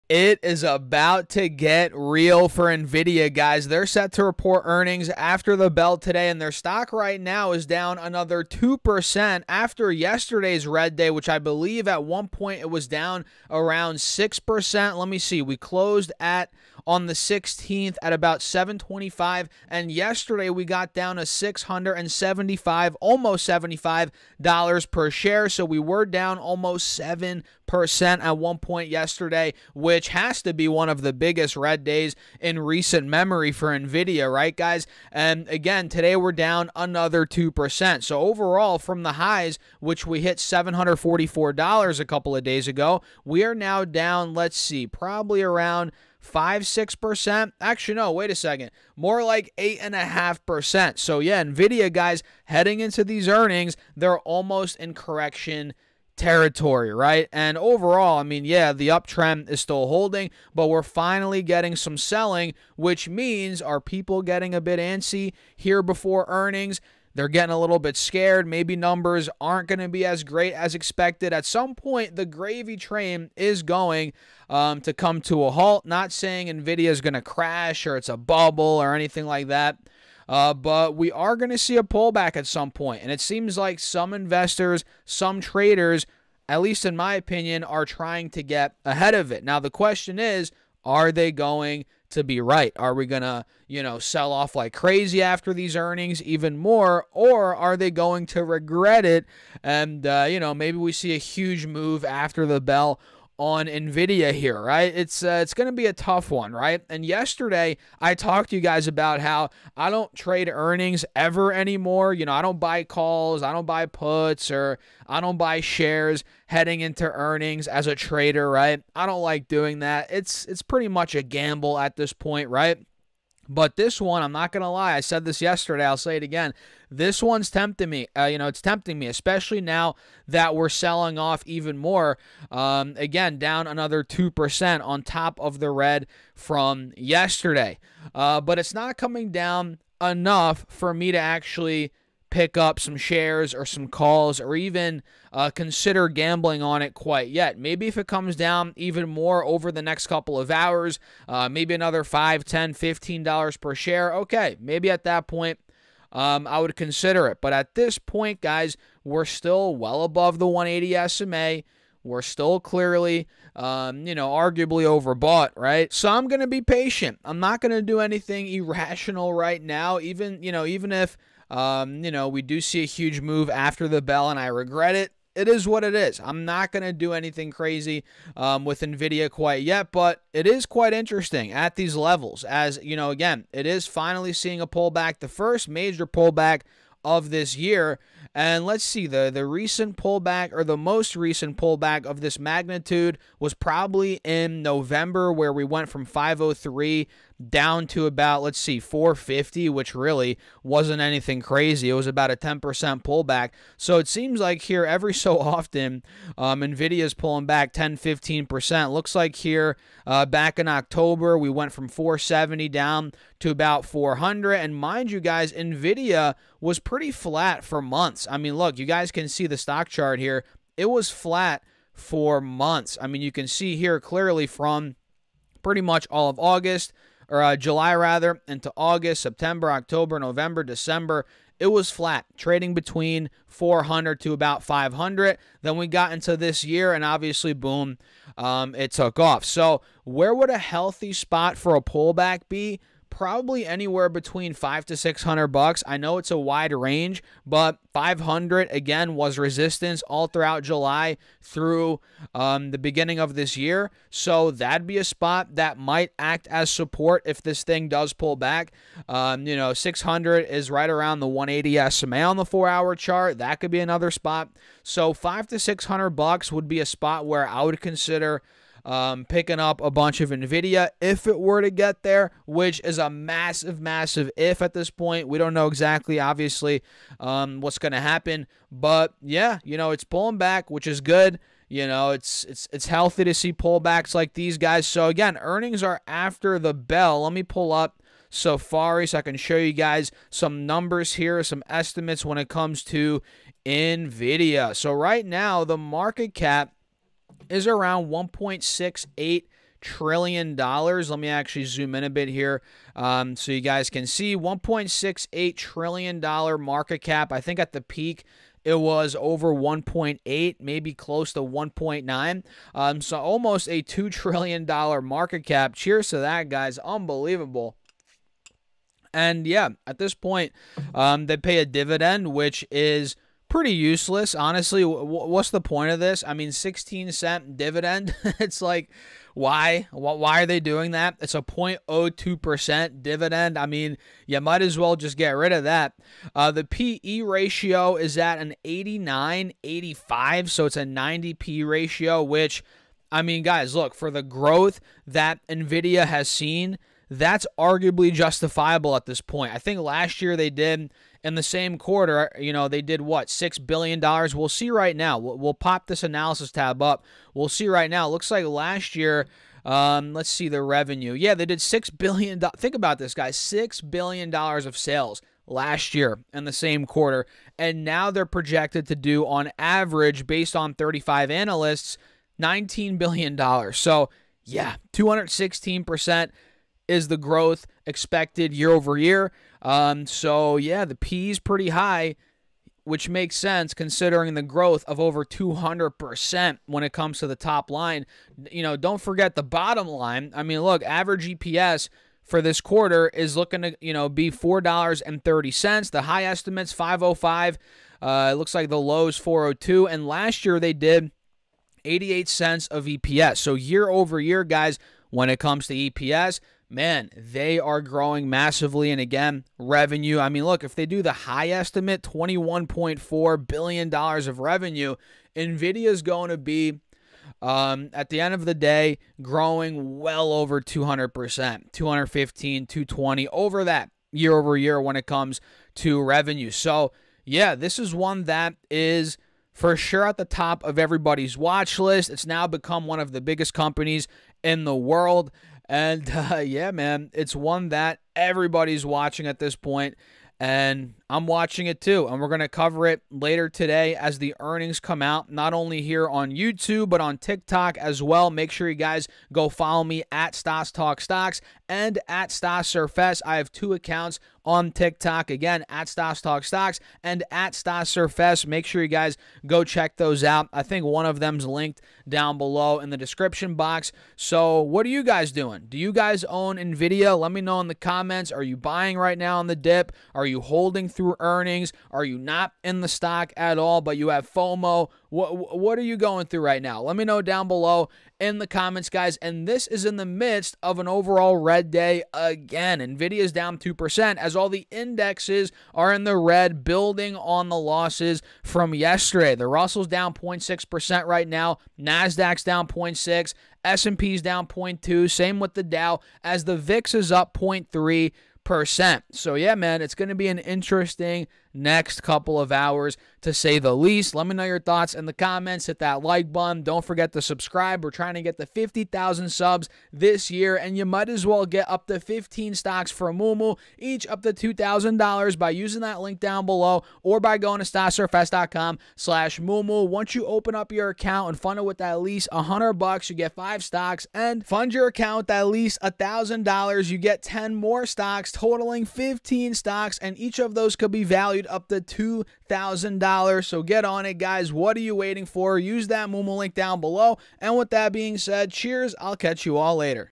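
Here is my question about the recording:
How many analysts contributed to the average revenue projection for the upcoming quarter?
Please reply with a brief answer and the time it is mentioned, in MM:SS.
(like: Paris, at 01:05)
35, at 06:10.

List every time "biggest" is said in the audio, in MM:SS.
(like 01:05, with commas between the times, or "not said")
00:31, 07:13.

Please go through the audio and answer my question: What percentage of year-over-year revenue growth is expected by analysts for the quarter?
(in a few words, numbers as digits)
216%.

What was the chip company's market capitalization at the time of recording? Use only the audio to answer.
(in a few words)
1.68 trillion dollars.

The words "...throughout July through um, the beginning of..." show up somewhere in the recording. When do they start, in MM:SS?
04:10.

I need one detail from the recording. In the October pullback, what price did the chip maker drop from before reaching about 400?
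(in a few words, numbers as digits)
470.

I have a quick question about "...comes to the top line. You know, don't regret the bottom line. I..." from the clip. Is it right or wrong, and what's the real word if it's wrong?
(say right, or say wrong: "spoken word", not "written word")
wrong: "forget", not "regret".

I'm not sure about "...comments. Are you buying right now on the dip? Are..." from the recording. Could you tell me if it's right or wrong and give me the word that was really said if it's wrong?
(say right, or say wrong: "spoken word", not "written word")
right.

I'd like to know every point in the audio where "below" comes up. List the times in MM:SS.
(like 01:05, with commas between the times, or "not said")
07:42, 07:57, 08:36, 08:56.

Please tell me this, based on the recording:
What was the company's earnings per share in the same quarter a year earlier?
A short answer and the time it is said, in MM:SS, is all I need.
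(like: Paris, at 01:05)
88 cents, at 06:41.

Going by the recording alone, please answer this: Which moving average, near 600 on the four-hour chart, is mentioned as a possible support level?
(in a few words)
180 SMA.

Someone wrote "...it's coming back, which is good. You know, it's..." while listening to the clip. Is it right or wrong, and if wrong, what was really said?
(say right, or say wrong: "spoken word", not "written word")
wrong: "pulling", not "coming".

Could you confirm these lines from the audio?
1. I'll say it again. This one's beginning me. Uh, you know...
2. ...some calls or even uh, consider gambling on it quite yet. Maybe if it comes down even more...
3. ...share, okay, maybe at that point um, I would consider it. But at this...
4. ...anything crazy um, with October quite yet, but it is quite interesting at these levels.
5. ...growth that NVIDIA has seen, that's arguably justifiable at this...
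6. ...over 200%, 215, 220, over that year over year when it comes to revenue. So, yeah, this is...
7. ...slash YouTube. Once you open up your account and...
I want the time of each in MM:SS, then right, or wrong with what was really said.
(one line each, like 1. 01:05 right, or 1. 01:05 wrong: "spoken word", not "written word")
1. 02:05 wrong: "tempting", not "beginning"
2. 02:23 right
3. 02:33 right
4. 02:57 wrong: "NVIDIA", not "October"
5. 05:44 right
6. 07:00 right
7. 08:38 wrong: "Moomoo", not "YouTube".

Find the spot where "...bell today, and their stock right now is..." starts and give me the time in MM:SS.
00:05.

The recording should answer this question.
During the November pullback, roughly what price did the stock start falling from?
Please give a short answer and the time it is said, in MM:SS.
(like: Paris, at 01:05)
503, at 03:16.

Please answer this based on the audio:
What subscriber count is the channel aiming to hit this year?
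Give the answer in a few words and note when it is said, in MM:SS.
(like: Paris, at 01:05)
50,000, at 08:28.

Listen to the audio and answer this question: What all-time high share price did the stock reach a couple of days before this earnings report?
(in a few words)
$744.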